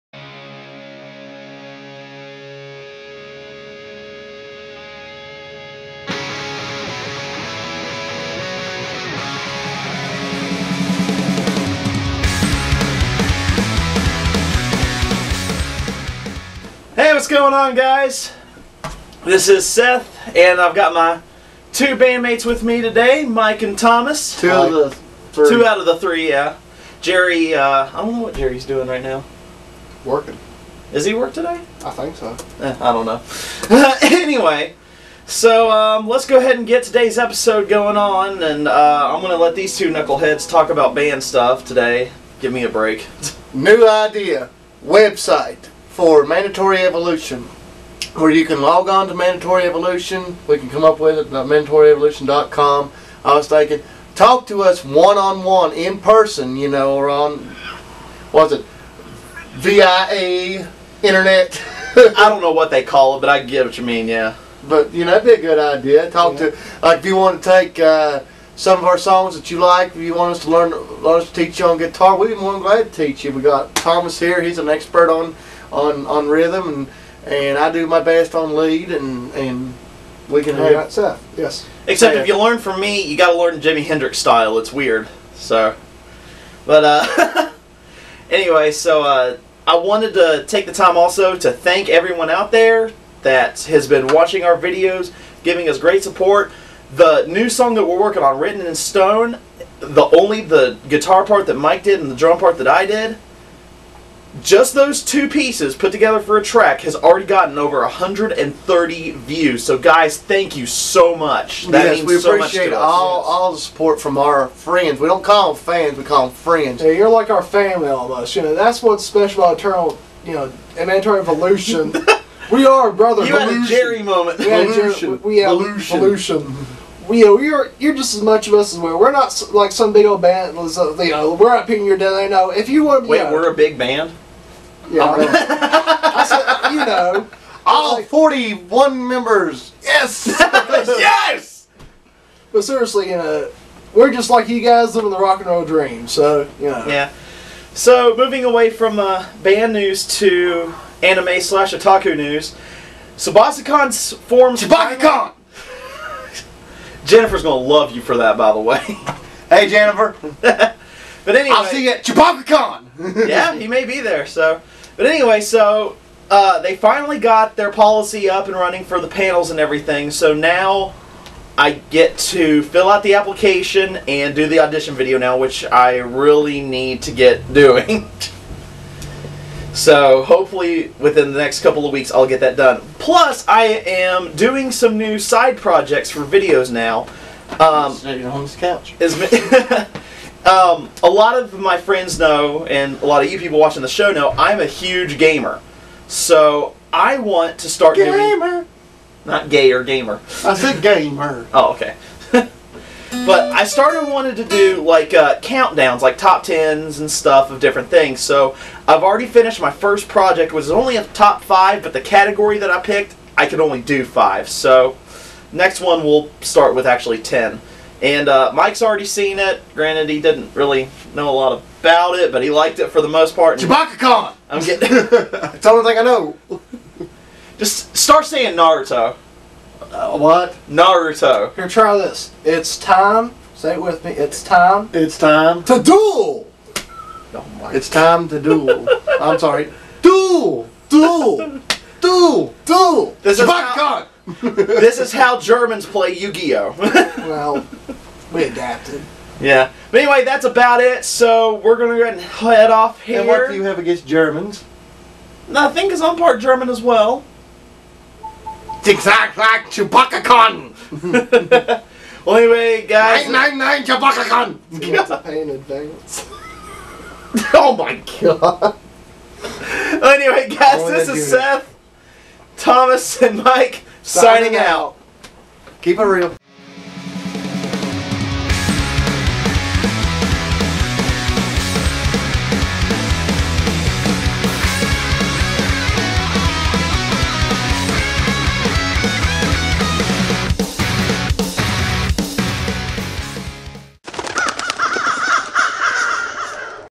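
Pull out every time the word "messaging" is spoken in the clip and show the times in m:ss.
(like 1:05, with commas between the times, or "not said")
not said.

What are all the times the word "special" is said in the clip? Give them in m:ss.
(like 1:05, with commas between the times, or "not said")
1:59.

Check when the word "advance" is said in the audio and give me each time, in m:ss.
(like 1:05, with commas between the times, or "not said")
4:25.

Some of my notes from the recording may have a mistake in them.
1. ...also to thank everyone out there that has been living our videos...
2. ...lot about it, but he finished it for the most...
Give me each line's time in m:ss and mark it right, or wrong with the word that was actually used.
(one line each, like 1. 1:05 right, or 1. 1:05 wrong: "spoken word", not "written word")
1. 1:30 wrong: "watching", not "living"
2. 3:41 wrong: "liked", not "finished".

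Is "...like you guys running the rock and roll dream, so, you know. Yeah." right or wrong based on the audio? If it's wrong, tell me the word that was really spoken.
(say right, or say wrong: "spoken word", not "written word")
wrong: "living", not "running".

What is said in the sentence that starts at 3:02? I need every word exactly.
Plus, I am doing some new side projects for videos now.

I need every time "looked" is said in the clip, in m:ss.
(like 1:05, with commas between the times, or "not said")
not said.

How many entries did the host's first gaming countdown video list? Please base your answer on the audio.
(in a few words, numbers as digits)
top 5.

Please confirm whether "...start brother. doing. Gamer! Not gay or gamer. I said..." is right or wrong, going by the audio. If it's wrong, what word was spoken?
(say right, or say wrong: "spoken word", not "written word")
wrong: "gamer", not "brother".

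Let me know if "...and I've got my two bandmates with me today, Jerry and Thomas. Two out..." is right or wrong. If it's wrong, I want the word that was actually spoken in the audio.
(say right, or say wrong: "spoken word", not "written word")
wrong: "Mike", not "Jerry".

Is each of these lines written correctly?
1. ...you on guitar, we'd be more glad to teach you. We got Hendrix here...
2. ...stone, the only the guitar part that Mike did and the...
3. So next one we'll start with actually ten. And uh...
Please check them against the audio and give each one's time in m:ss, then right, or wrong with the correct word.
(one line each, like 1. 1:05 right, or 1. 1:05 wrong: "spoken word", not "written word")
1. 1:11 wrong: "Thomas", not "Hendrix"
2. 1:38 right
3. 3:34 right.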